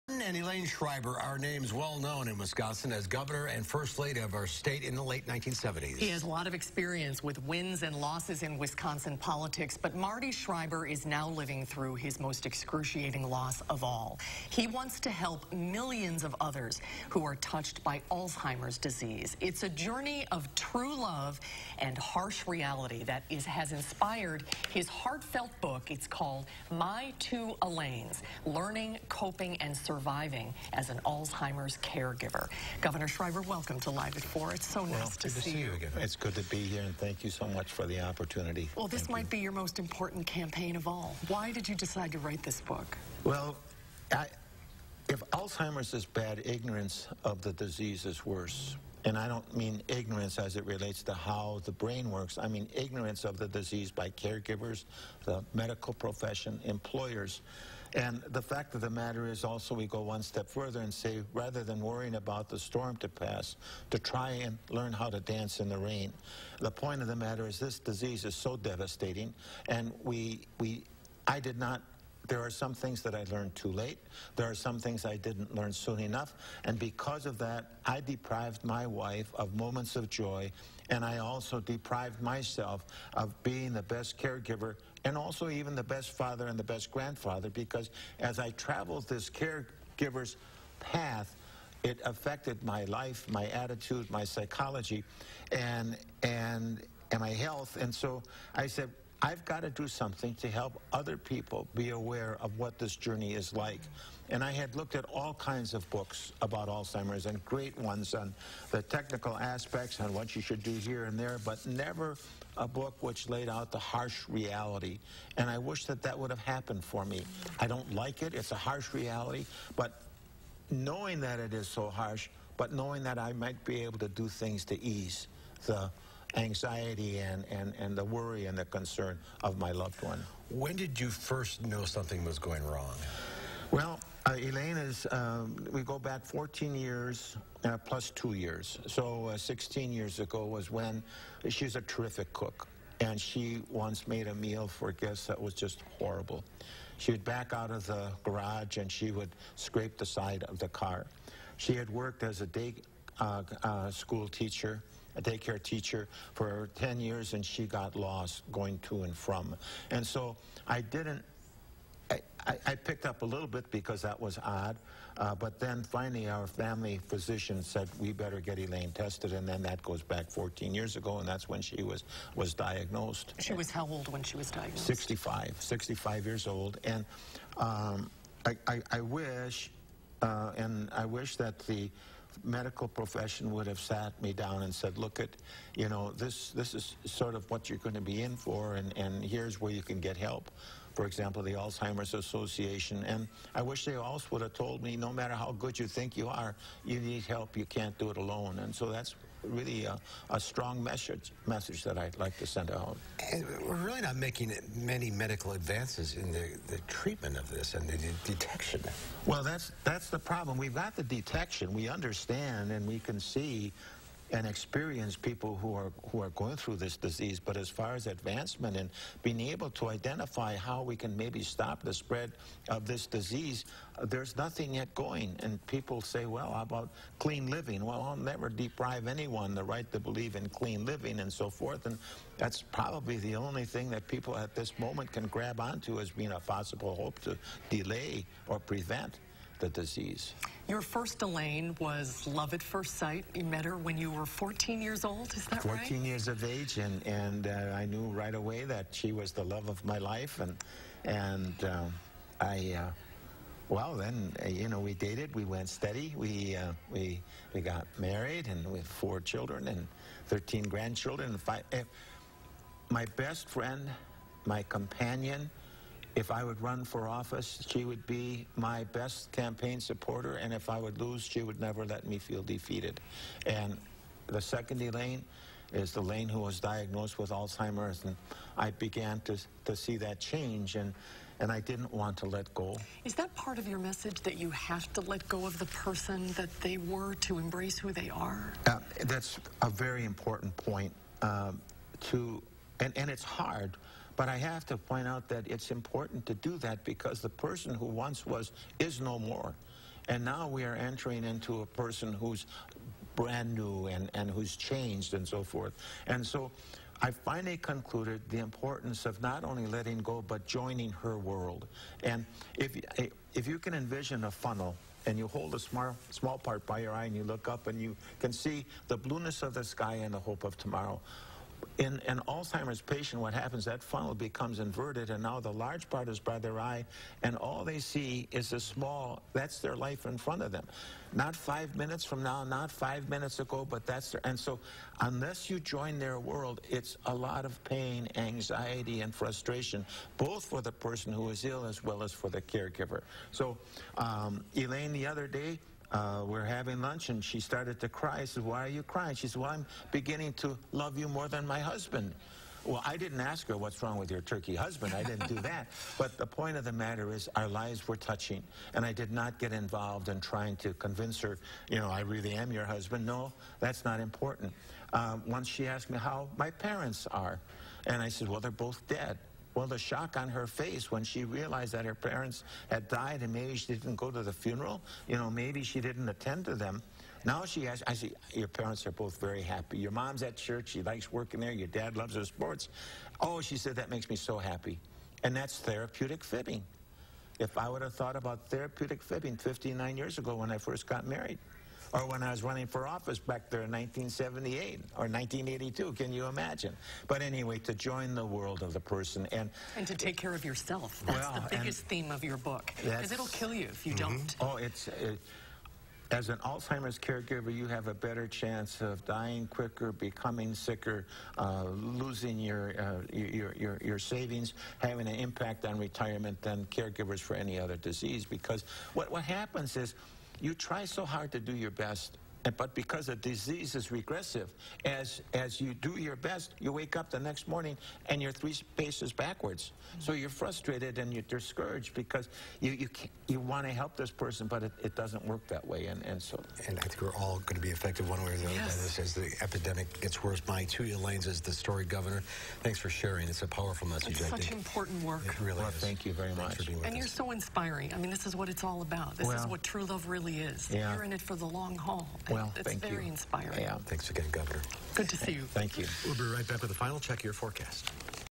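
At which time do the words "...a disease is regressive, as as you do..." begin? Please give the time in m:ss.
7:03.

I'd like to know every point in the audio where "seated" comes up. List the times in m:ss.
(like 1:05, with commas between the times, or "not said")
not said.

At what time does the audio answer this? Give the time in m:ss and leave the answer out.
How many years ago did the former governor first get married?
6:29.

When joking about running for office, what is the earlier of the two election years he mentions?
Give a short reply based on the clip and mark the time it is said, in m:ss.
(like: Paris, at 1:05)
1978, at 6:33.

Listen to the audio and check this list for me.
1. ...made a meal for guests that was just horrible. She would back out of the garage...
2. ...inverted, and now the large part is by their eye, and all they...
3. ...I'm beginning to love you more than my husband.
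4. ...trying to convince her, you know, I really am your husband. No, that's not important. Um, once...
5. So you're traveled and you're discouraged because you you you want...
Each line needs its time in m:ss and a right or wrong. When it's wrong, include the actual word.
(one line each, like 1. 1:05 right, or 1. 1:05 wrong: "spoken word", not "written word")
1. 2:24 right
2. 5:24 right
3. 5:49 right
4. 6:00 right
5. 7:10 wrong: "frustrated", not "traveled".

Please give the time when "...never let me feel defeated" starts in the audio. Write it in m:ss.
4:31.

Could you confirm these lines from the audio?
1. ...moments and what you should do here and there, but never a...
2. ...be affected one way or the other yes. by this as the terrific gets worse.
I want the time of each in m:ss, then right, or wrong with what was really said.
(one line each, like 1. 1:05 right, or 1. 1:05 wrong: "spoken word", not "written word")
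1. 1:49 wrong: "aspects", not "moments"
2. 7:17 wrong: "epidemic", not "terrific".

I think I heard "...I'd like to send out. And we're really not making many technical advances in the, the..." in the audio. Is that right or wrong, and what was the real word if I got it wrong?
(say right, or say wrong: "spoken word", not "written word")
wrong: "medical", not "technical".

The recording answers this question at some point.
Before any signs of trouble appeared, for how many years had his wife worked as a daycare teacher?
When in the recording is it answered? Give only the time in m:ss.
2:36.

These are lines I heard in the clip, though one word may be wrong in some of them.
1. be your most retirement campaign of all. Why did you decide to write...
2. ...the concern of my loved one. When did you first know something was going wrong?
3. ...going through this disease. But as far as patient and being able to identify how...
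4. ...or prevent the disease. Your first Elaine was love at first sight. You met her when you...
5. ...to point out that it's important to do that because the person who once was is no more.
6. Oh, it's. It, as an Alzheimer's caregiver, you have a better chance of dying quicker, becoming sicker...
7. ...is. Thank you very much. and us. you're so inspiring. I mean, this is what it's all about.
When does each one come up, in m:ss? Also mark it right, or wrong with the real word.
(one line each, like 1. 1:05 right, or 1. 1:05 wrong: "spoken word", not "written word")
1. 0:39 wrong: "important", not "retirement"
2. 2:08 right
3. 3:36 wrong: "advancement", not "patient"
4. 3:58 right
5. 4:54 right
6. 6:44 right
7. 7:25 right.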